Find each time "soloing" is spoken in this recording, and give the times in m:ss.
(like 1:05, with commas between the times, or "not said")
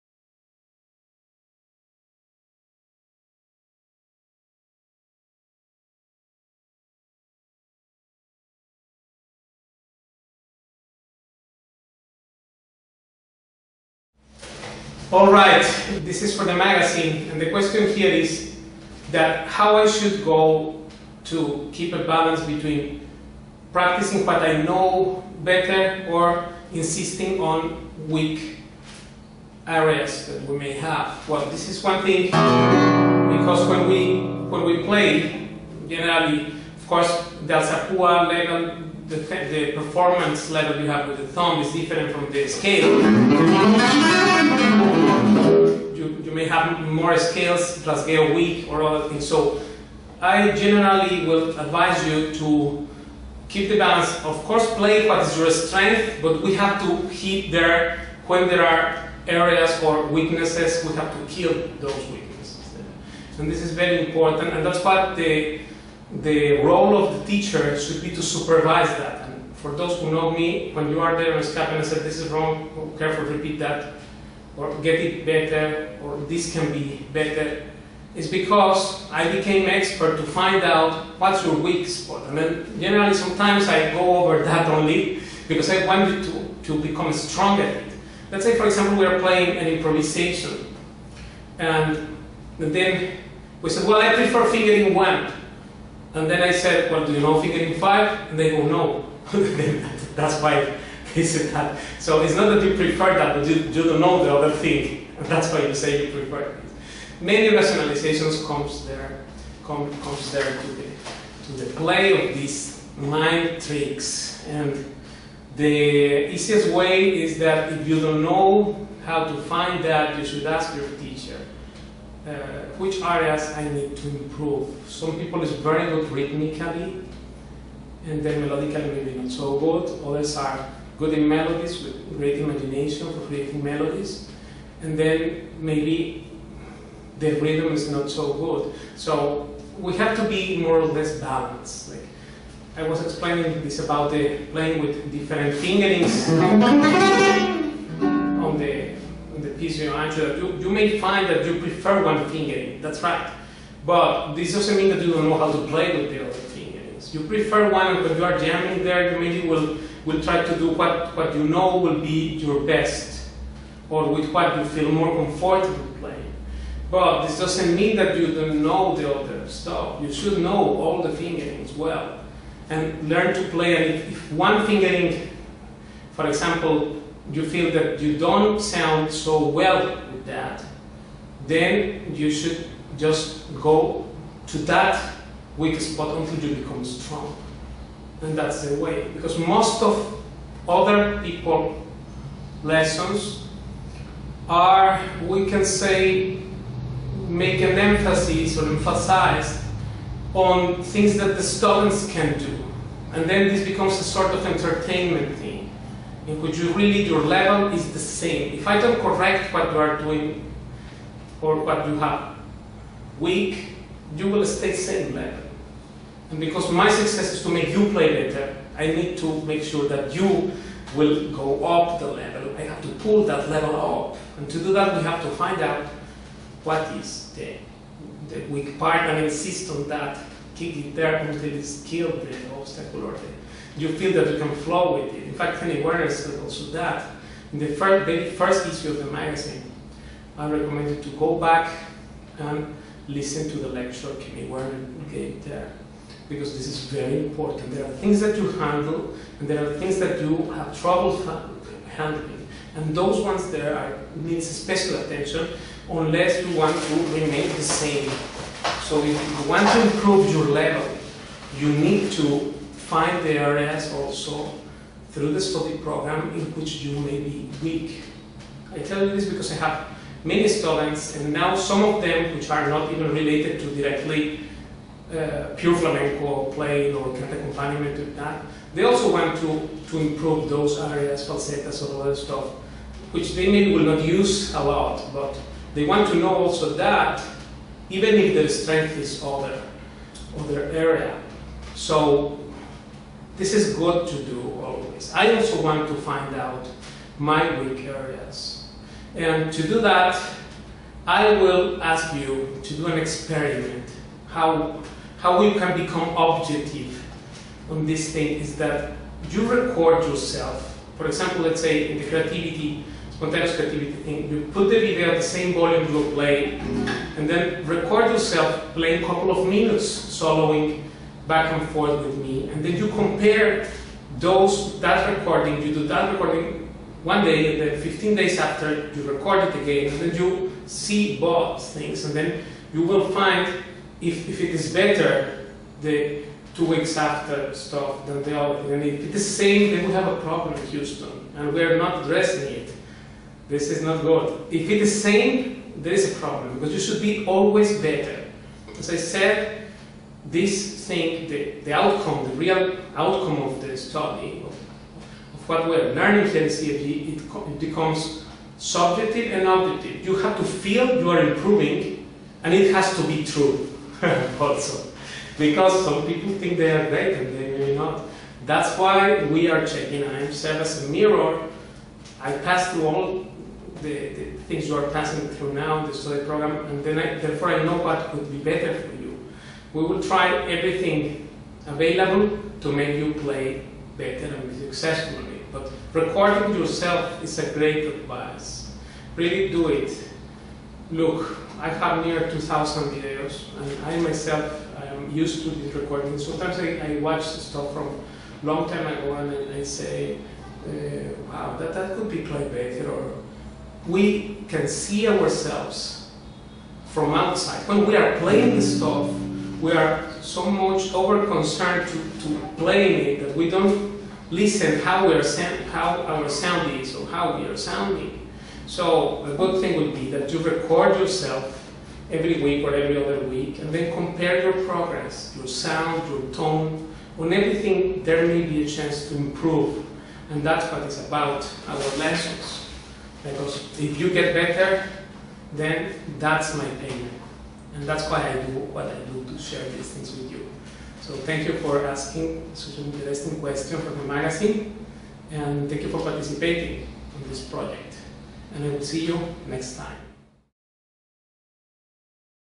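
5:19.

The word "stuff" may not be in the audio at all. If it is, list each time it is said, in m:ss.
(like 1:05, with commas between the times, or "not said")
2:49, 4:42, 5:37, 6:37, 6:48.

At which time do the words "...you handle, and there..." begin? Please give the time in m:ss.
4:08.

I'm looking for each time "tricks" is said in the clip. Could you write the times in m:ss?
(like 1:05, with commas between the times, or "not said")
1:53.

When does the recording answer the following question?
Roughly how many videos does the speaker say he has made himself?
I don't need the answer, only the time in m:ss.
6:32.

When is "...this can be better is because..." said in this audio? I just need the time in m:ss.
1:16.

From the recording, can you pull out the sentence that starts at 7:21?
So thank you for asking such an interesting question for the magazine.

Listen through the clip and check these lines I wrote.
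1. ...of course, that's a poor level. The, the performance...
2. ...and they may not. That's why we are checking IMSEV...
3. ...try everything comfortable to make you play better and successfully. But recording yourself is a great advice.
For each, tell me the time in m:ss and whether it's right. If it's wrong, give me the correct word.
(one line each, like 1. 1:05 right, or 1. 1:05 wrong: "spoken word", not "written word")
1. 0:36 right
2. 6:07 right
3. 6:20 wrong: "available", not "comfortable".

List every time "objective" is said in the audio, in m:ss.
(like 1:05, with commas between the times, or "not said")
5:06, 5:59.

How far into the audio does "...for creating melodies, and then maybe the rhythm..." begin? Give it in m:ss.
2:13.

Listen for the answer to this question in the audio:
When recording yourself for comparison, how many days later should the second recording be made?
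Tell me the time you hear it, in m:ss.
5:27.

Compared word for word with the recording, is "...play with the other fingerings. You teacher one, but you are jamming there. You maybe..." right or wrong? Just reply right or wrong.
wrong.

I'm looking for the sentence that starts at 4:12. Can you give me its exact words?
And those ones there are, needs special attention unless you want to remain the same.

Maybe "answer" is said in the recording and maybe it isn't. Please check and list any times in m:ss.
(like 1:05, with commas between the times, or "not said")
2:29.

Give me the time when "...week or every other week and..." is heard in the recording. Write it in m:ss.
7:02.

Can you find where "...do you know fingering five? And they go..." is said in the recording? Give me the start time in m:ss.
1:37.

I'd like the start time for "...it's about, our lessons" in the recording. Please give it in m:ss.
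7:10.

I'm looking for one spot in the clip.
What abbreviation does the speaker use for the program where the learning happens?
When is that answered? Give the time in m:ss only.
5:56.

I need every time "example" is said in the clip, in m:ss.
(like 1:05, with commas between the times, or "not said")
1:28, 2:56, 5:11.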